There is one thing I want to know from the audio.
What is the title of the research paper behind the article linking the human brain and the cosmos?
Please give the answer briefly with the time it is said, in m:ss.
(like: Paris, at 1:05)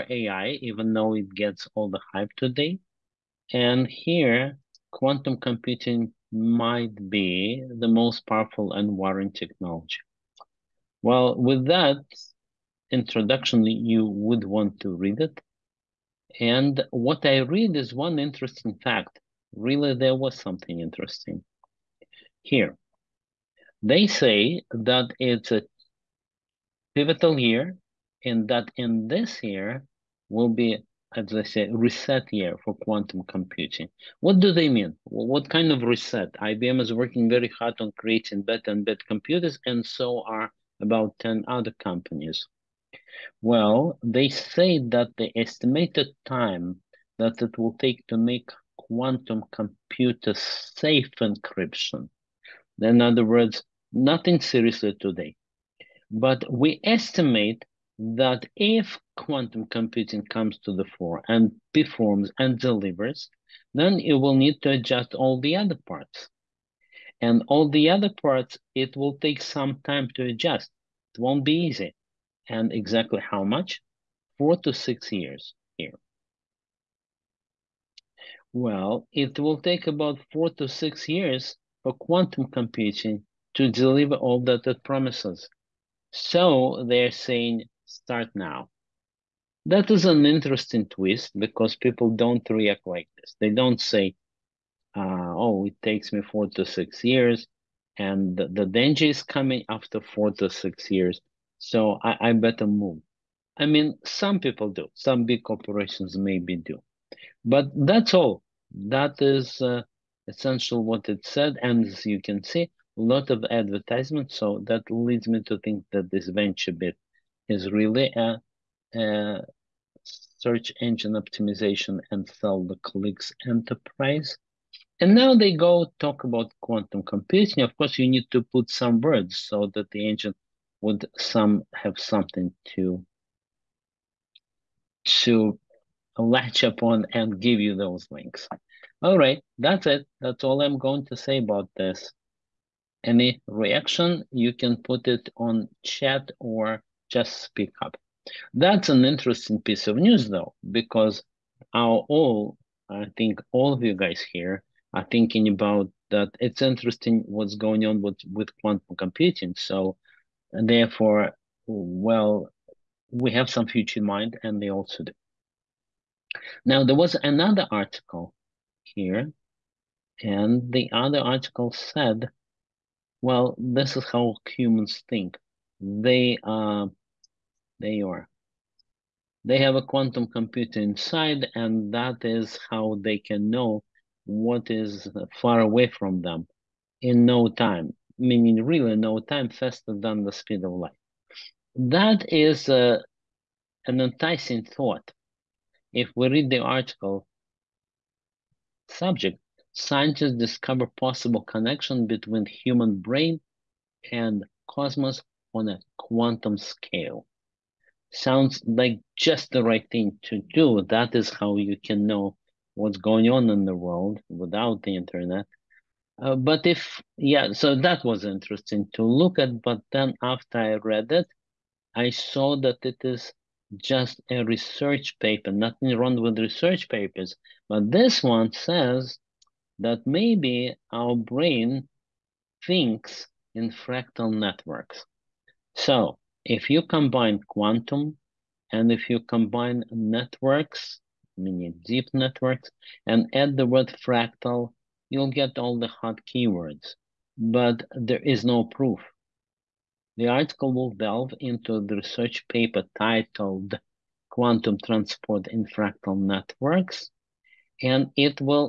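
Quantum Transport in Fractal Networks, at 4:14.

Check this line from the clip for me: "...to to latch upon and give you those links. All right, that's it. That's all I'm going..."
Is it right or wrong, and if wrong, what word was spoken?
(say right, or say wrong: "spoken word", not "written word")
right.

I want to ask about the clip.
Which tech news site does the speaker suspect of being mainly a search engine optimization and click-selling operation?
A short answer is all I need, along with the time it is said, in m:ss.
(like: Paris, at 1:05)
VentureBeat, at 1:56.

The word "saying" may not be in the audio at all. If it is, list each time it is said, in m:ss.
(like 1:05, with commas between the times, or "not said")
1:27.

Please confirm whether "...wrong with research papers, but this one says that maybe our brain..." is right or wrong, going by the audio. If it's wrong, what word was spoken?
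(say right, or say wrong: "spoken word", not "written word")
right.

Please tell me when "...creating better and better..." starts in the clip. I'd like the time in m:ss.
0:37.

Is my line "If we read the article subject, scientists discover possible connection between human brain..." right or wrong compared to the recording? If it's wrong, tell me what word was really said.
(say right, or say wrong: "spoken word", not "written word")
right.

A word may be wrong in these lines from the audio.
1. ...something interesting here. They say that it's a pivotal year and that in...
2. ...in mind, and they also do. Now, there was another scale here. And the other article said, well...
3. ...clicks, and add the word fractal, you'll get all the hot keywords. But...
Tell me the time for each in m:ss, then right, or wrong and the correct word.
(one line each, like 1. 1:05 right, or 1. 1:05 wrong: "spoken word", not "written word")
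1. 0:20 right
2. 2:43 wrong: "article", not "scale"
3. 4:02 wrong: "networks", not "clicks".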